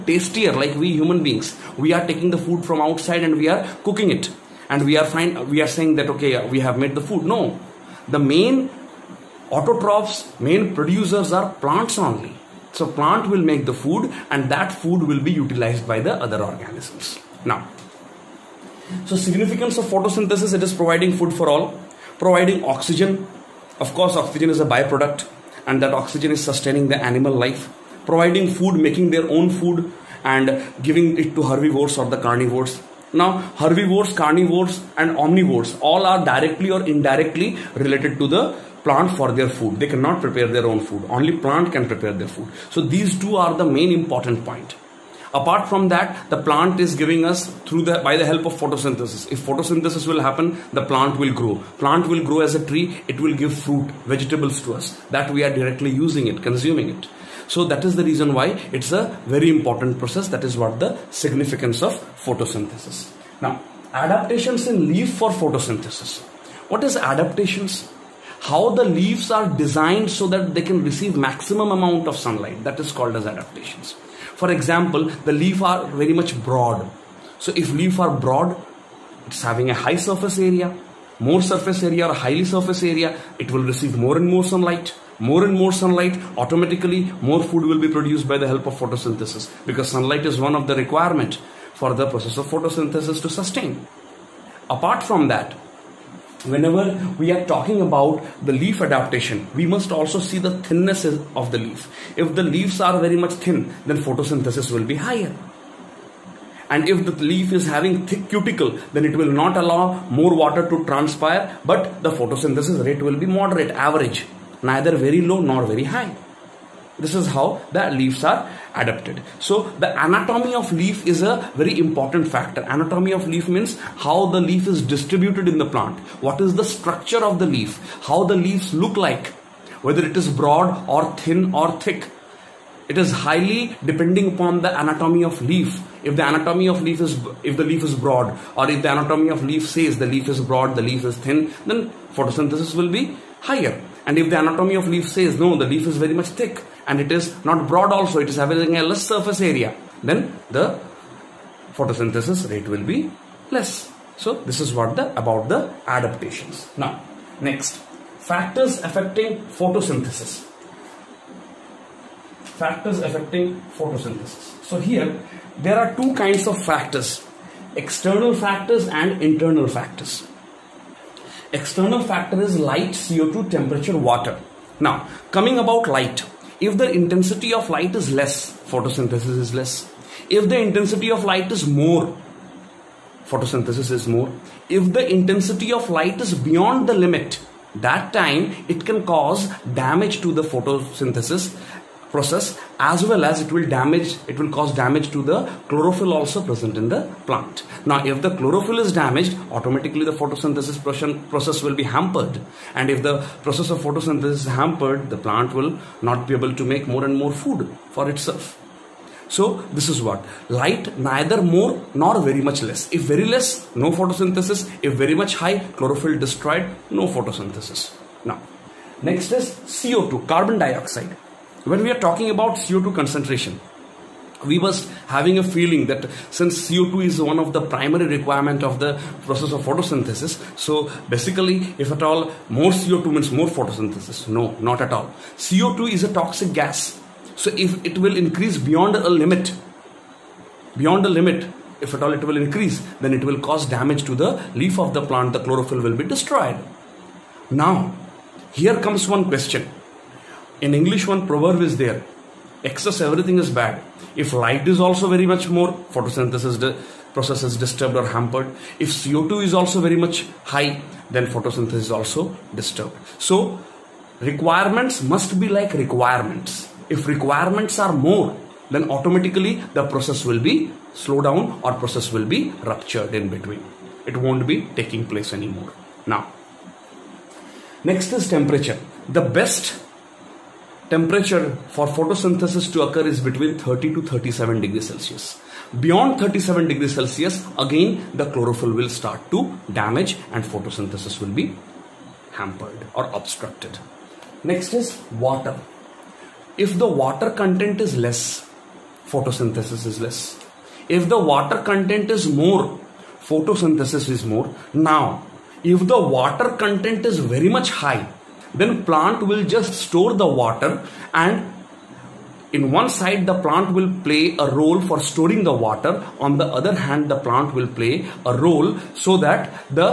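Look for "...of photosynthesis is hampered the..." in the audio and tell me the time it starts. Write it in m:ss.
3:23.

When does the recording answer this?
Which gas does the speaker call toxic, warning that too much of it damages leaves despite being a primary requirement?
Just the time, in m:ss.
3:55.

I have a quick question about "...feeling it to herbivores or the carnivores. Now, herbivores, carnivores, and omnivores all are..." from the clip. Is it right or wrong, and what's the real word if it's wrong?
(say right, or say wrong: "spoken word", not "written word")
wrong: "giving", not "feeling".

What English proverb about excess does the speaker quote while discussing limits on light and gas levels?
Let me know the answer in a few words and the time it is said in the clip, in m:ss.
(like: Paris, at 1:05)
Excess everything is bad, at 4:12.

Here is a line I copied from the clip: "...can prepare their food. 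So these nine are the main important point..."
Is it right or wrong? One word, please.
wrong.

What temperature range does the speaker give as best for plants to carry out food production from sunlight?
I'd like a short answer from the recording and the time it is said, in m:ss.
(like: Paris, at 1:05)
30 to 37 degrees Celsius, at 4:43.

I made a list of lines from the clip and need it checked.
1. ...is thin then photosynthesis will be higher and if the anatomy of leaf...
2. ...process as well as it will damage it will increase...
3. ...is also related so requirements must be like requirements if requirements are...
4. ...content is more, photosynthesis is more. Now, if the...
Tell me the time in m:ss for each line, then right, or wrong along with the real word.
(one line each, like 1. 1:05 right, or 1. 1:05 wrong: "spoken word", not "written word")
1. 2:21 right
2. 3:12 wrong: "cause", not "increase"
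3. 4:21 wrong: "disturbed", not "related"
4. 5:01 right.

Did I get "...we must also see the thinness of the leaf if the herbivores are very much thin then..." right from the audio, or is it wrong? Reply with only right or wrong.
wrong.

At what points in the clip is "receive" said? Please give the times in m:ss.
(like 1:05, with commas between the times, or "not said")
1:10, 1:23.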